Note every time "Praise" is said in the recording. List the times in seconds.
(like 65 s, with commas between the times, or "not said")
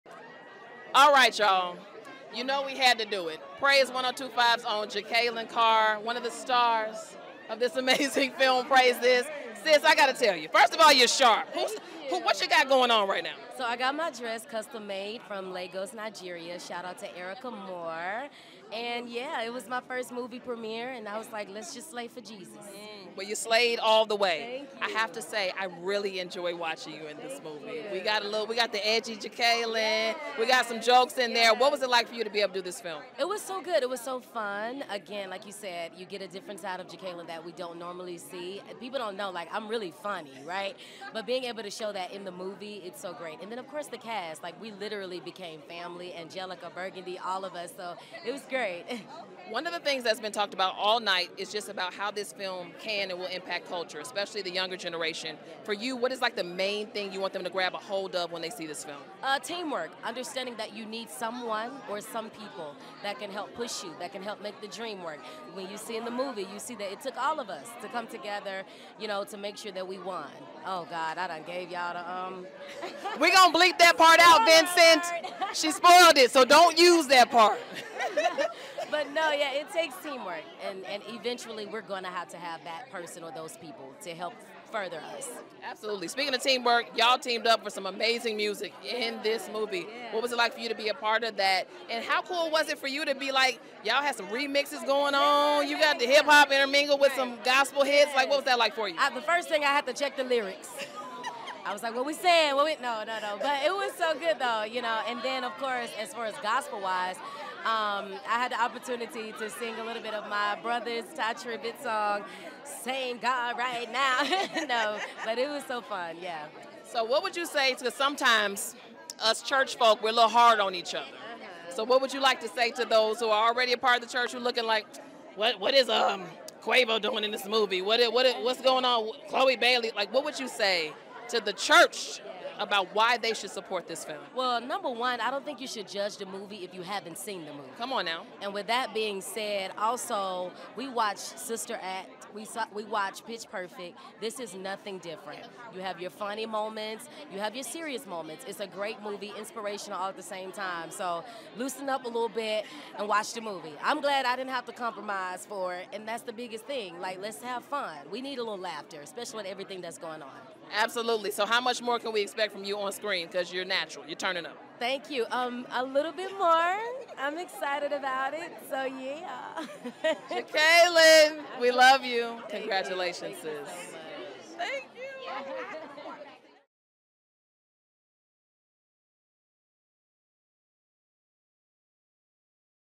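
3 s, 8 s.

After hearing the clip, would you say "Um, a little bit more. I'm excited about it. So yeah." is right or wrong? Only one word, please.
right.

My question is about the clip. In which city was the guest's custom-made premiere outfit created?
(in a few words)
Lagos, Nigeria.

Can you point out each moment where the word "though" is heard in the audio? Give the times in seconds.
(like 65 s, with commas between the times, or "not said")
104 s.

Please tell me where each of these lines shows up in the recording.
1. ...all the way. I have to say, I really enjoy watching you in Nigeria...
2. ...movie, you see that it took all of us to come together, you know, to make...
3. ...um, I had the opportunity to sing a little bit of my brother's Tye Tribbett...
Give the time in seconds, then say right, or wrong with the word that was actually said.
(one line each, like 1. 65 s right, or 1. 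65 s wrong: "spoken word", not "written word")
1. 23 s wrong: "Thank", not "Nigeria"
2. 66 s right
3. 107 s right.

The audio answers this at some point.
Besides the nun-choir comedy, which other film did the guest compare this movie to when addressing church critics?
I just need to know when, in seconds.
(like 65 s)
143 s.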